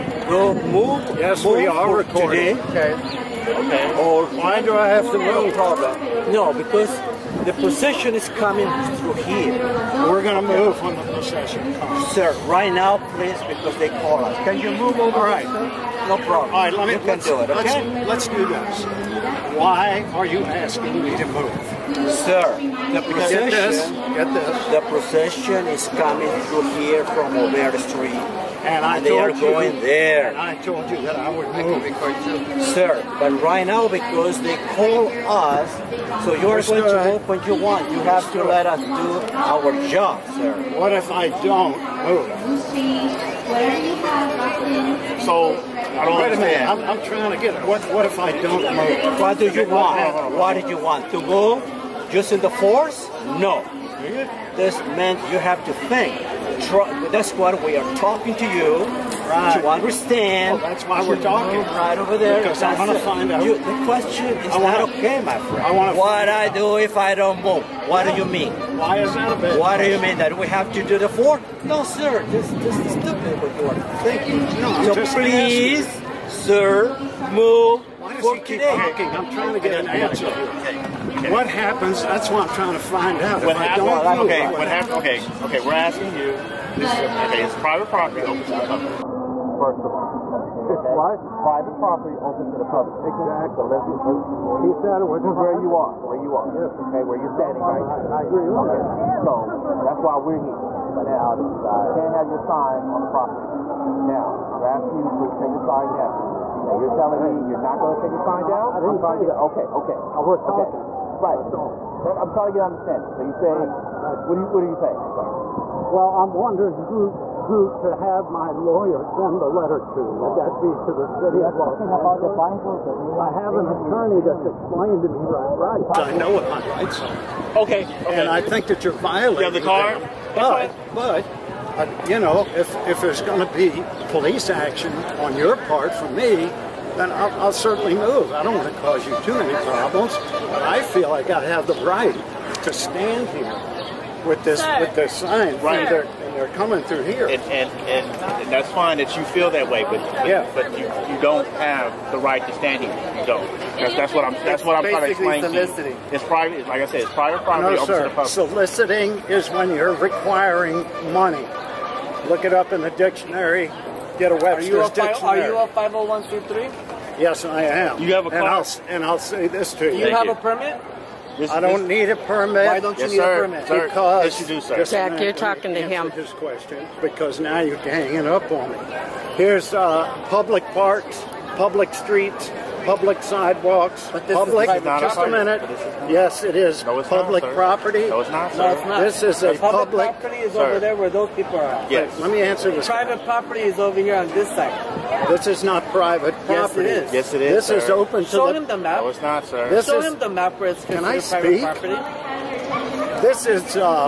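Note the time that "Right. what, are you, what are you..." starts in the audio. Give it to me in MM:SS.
01:54.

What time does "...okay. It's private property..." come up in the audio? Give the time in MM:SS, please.
01:26.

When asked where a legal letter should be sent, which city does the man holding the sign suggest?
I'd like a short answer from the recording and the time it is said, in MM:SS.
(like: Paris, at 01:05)
Los Angeles, at 02:01.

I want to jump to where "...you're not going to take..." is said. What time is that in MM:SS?
01:47.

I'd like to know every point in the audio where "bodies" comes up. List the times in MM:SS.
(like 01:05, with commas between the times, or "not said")
not said.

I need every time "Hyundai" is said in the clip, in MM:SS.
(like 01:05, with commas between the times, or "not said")
not said.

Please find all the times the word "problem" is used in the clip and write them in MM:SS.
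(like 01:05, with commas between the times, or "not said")
00:05, 00:16, 02:19.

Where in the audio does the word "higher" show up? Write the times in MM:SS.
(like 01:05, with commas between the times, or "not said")
not said.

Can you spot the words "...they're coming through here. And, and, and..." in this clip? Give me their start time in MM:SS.
02:26.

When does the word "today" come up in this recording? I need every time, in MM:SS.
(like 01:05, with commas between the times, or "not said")
00:02, 01:18.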